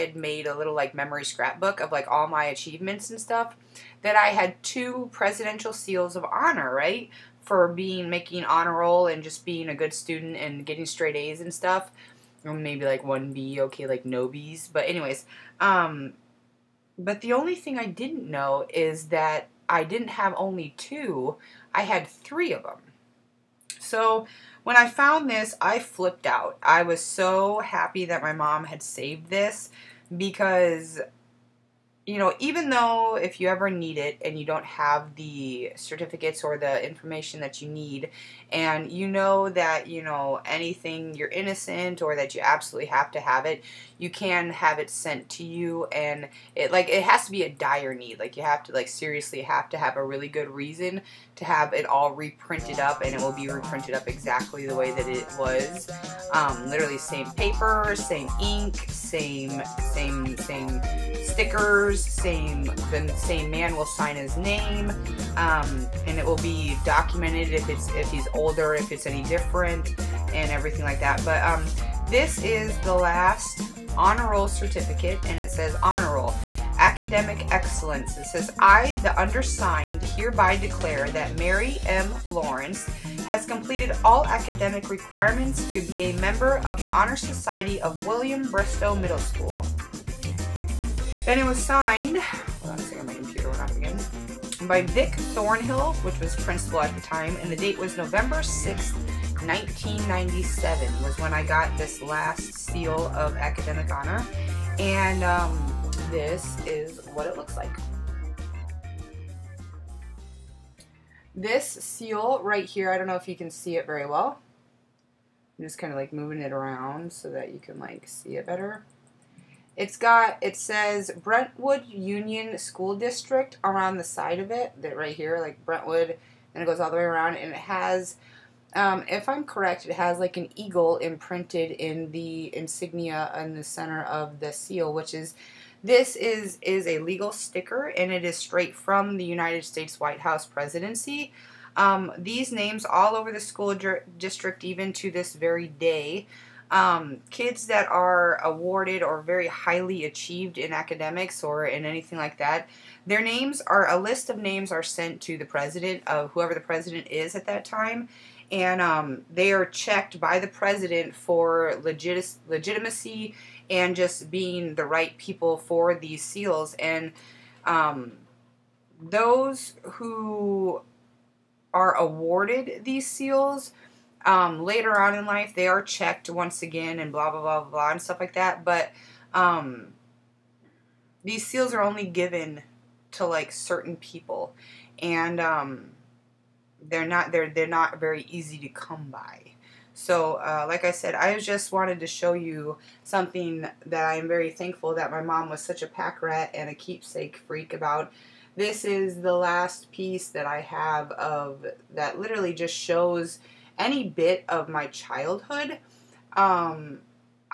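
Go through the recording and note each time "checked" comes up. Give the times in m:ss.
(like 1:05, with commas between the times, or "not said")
2:39, 2:55.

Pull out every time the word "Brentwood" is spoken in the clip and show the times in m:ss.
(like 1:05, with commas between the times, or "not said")
2:01, 2:05.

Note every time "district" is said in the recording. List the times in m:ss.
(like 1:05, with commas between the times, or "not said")
2:02, 2:24.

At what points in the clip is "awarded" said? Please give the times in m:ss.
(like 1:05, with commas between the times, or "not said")
2:28, 2:51.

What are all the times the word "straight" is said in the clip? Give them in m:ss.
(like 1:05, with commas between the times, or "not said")
0:10, 2:18.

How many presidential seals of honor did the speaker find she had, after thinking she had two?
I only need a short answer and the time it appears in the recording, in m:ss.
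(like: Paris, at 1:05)
3, at 0:22.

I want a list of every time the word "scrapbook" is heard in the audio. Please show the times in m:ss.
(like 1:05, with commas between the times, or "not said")
0:01.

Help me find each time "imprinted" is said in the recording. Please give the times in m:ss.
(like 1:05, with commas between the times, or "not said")
2:10.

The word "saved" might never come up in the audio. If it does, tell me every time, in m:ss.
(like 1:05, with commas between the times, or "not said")
0:28.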